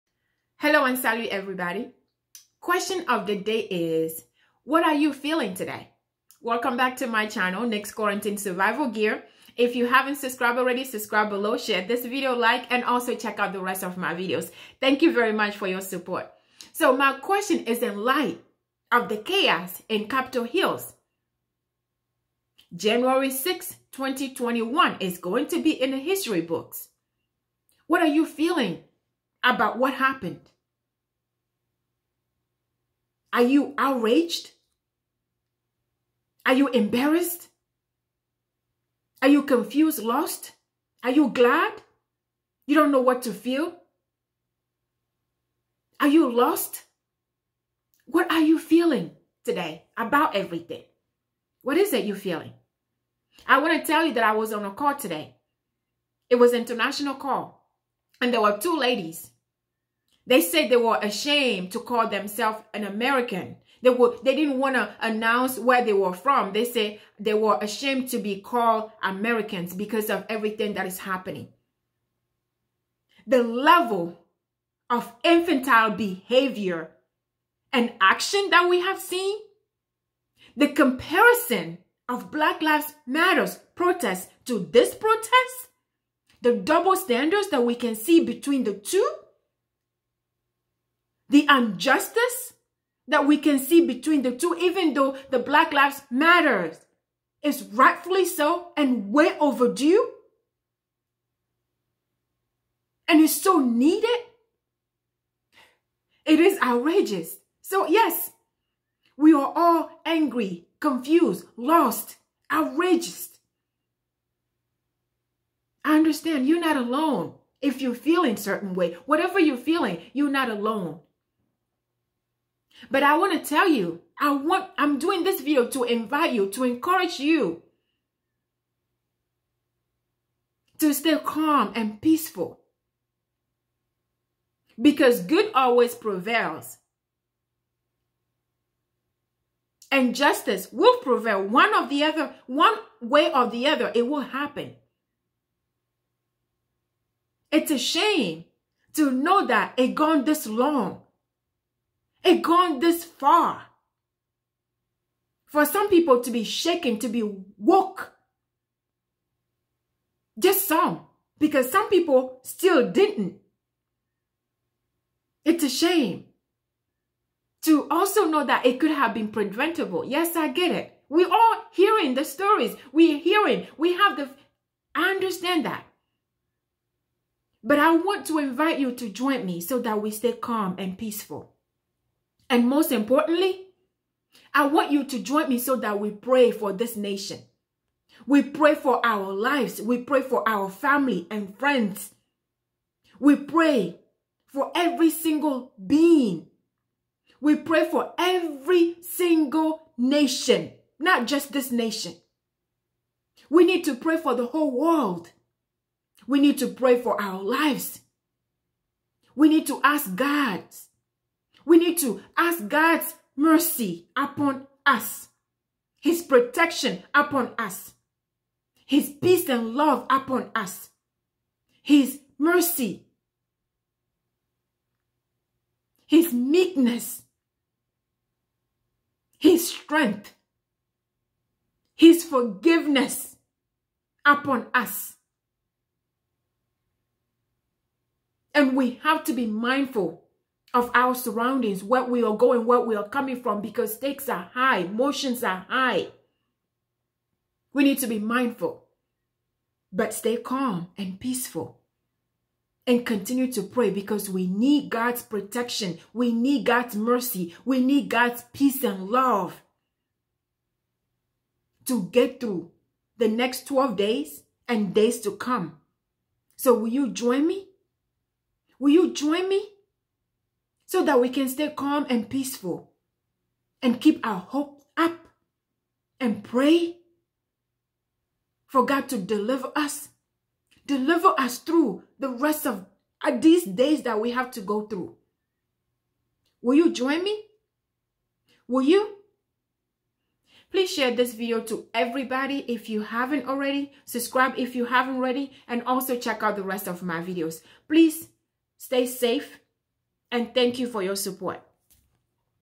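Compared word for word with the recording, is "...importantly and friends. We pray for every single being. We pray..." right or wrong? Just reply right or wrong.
wrong.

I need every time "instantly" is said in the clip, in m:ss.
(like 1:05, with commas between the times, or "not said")
not said.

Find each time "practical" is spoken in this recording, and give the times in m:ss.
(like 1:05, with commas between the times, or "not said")
not said.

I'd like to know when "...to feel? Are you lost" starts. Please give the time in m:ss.
0:43.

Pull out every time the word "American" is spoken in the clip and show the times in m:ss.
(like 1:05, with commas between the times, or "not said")
1:02, 1:09.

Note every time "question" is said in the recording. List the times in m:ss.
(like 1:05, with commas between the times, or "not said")
0:02, 0:17.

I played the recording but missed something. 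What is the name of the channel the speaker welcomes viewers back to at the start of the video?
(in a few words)
Next Quarantine Survival Gear.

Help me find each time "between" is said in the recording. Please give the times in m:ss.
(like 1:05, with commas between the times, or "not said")
1:28, 1:33.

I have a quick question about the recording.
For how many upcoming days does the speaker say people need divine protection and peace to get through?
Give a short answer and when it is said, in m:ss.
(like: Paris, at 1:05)
12, at 4:23.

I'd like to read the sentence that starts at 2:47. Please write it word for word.
To also know that it could have been preventable.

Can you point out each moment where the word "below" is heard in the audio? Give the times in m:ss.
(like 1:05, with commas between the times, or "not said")
0:11.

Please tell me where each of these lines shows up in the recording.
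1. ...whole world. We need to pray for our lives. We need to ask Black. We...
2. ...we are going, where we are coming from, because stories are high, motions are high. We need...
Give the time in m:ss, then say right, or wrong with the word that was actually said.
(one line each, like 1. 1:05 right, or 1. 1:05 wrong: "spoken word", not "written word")
1. 3:24 wrong: "God", not "Black"
2. 4:02 wrong: "stakes", not "stories".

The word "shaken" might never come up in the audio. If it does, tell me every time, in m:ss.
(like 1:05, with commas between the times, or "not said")
2:36.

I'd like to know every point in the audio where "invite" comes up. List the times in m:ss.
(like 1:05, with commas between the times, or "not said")
2:05, 2:58.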